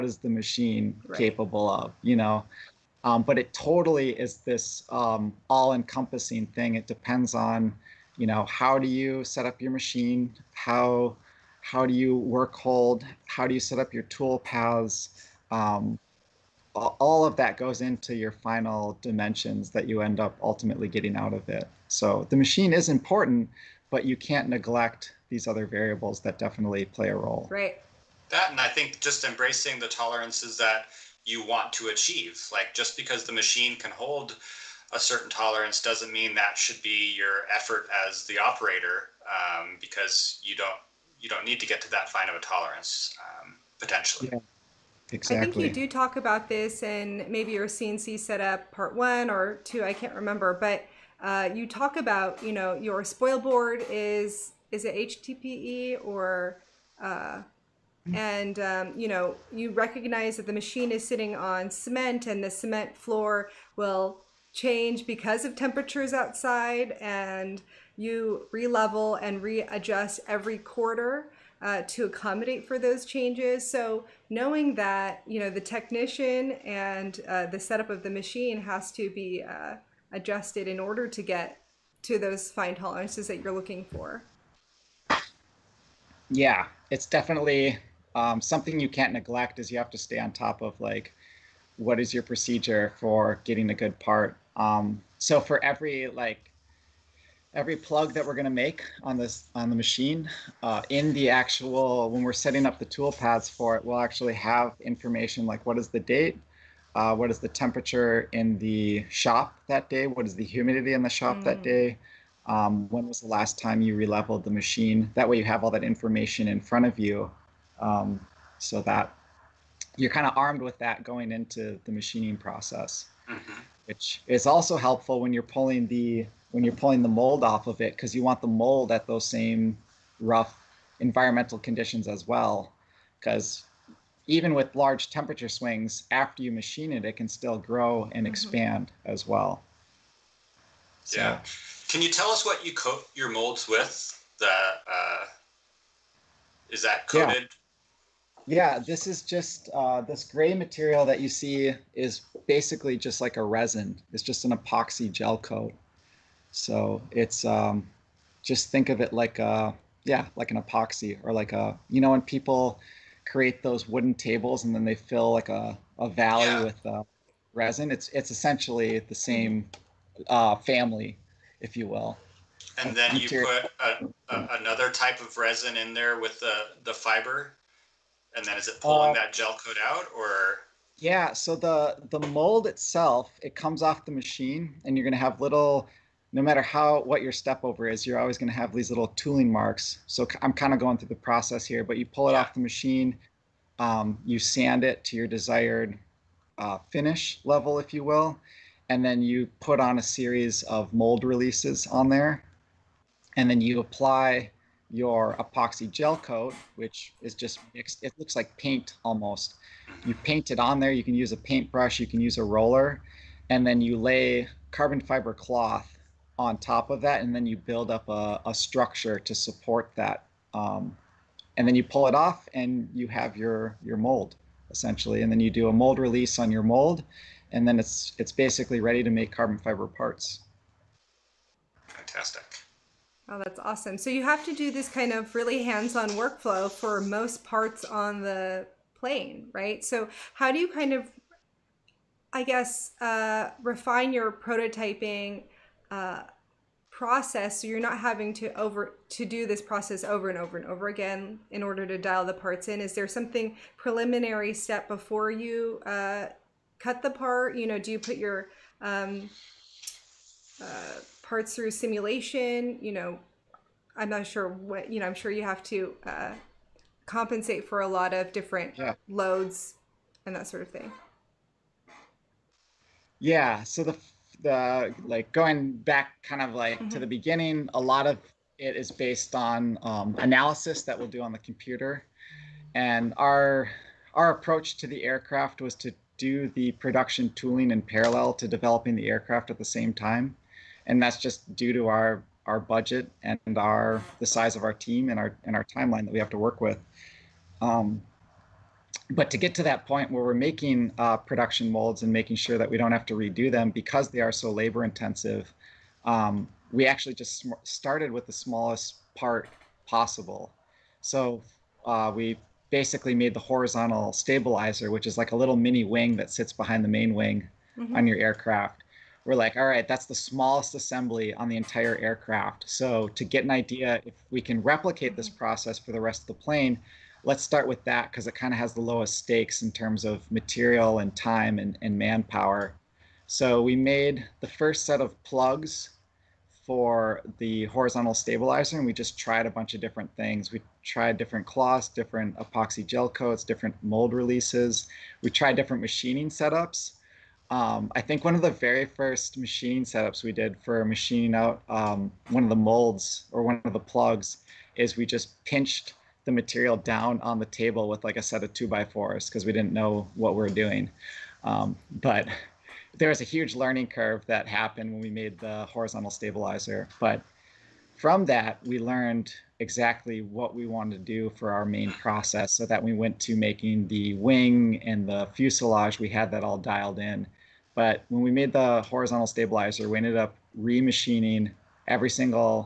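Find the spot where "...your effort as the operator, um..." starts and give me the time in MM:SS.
00:37.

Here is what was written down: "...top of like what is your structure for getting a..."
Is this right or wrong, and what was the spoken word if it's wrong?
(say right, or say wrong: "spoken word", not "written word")
wrong: "procedure", not "structure".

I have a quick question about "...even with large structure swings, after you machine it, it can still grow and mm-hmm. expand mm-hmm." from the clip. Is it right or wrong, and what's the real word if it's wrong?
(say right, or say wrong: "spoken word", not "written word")
wrong: "temperature", not "structure".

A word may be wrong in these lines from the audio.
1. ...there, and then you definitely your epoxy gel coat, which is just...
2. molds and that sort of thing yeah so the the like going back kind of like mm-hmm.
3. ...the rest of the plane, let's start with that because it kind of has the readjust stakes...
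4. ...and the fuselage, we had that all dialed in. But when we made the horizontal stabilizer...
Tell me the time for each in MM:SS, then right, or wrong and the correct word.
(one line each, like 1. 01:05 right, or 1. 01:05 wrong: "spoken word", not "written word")
1. 03:22 wrong: "apply", not "definitely"
2. 04:29 wrong: "loads", not "molds"
3. 05:25 wrong: "lowest", not "readjust"
4. 06:14 right.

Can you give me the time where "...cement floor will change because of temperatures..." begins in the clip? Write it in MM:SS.
01:02.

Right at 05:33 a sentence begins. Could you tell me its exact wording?
So we made the first set of plugs for the horizontal stabilizer and we just tried a bunch of different things.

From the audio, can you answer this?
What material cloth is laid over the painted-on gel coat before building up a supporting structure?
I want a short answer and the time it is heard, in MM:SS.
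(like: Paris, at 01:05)
Carbon fiber cloth, at 03:34.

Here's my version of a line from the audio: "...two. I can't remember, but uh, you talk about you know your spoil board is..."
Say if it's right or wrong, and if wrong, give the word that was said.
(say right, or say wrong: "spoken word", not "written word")
right.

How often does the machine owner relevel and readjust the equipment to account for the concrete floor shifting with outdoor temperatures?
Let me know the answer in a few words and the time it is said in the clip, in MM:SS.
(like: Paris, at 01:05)
Every quarter, at 01:10.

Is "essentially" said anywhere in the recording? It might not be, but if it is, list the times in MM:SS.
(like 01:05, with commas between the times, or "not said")
02:48, 03:44.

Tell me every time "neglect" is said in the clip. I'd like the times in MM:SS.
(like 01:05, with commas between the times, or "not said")
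00:24, 01:29.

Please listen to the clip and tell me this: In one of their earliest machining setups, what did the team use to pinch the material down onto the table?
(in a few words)
Two by fours.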